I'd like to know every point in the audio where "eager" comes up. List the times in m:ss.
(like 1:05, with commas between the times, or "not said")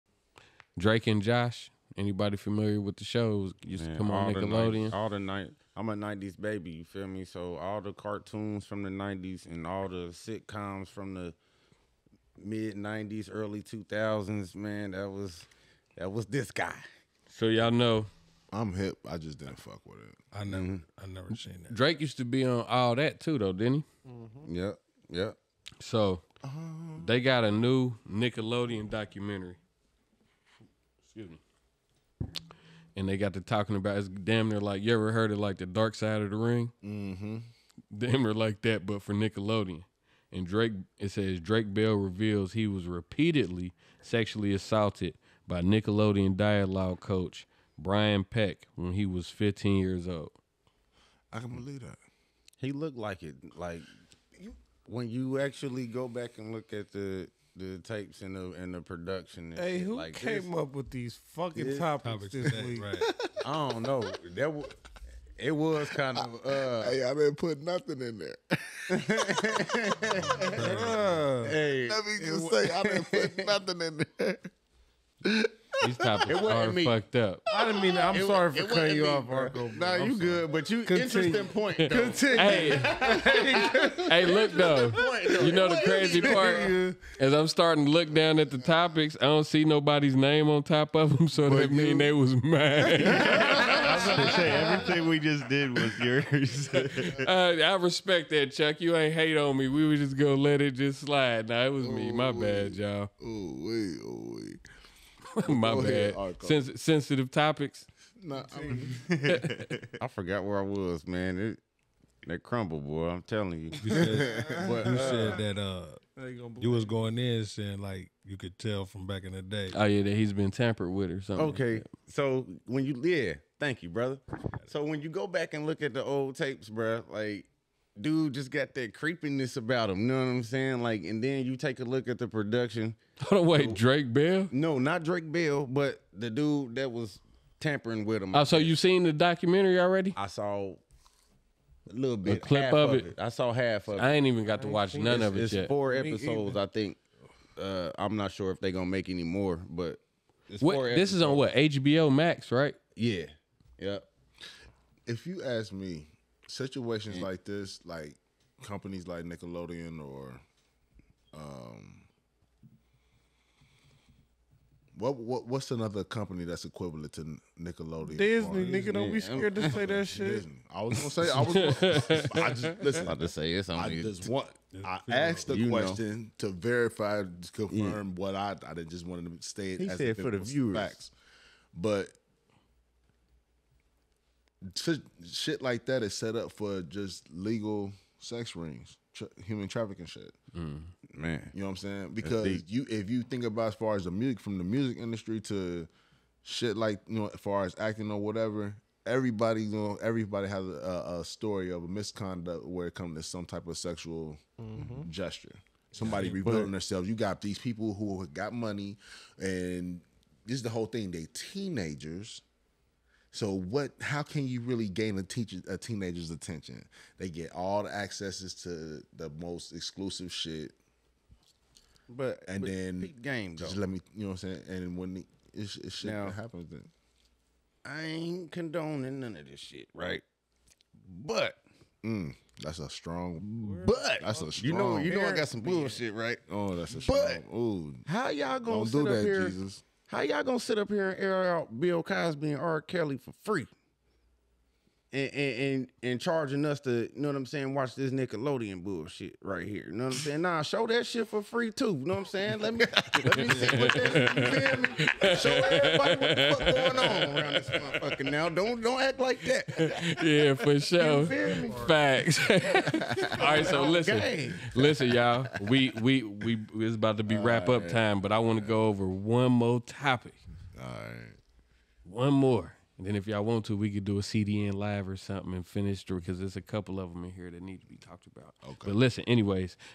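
not said.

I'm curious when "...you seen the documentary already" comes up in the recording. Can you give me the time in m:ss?
2:18.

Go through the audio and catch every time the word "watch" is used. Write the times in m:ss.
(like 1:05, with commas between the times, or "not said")
2:24, 4:07.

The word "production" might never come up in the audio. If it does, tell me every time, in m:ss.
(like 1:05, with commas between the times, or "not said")
0:58, 2:12.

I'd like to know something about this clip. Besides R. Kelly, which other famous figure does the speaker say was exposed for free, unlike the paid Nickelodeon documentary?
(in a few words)
Bill Cosby.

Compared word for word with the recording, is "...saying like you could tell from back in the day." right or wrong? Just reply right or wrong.
right.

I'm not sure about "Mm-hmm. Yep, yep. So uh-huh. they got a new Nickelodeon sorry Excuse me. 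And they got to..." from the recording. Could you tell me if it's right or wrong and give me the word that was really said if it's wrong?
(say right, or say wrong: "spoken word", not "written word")
wrong: "documentary", not "sorry".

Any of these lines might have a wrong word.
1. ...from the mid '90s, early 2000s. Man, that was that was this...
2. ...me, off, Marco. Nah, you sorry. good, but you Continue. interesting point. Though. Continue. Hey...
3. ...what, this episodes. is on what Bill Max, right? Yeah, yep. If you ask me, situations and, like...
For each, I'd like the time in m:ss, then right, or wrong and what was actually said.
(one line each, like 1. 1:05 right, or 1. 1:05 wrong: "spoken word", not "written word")
1. 0:10 right
2. 1:19 right
3. 2:30 wrong: "HBO", not "Bill".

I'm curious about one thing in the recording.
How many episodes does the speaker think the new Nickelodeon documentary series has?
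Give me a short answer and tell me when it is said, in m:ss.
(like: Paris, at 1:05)
4, at 2:25.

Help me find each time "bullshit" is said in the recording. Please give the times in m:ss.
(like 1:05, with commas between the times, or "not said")
3:55, 4:08.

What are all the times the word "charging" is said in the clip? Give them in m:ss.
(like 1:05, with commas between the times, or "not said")
4:06.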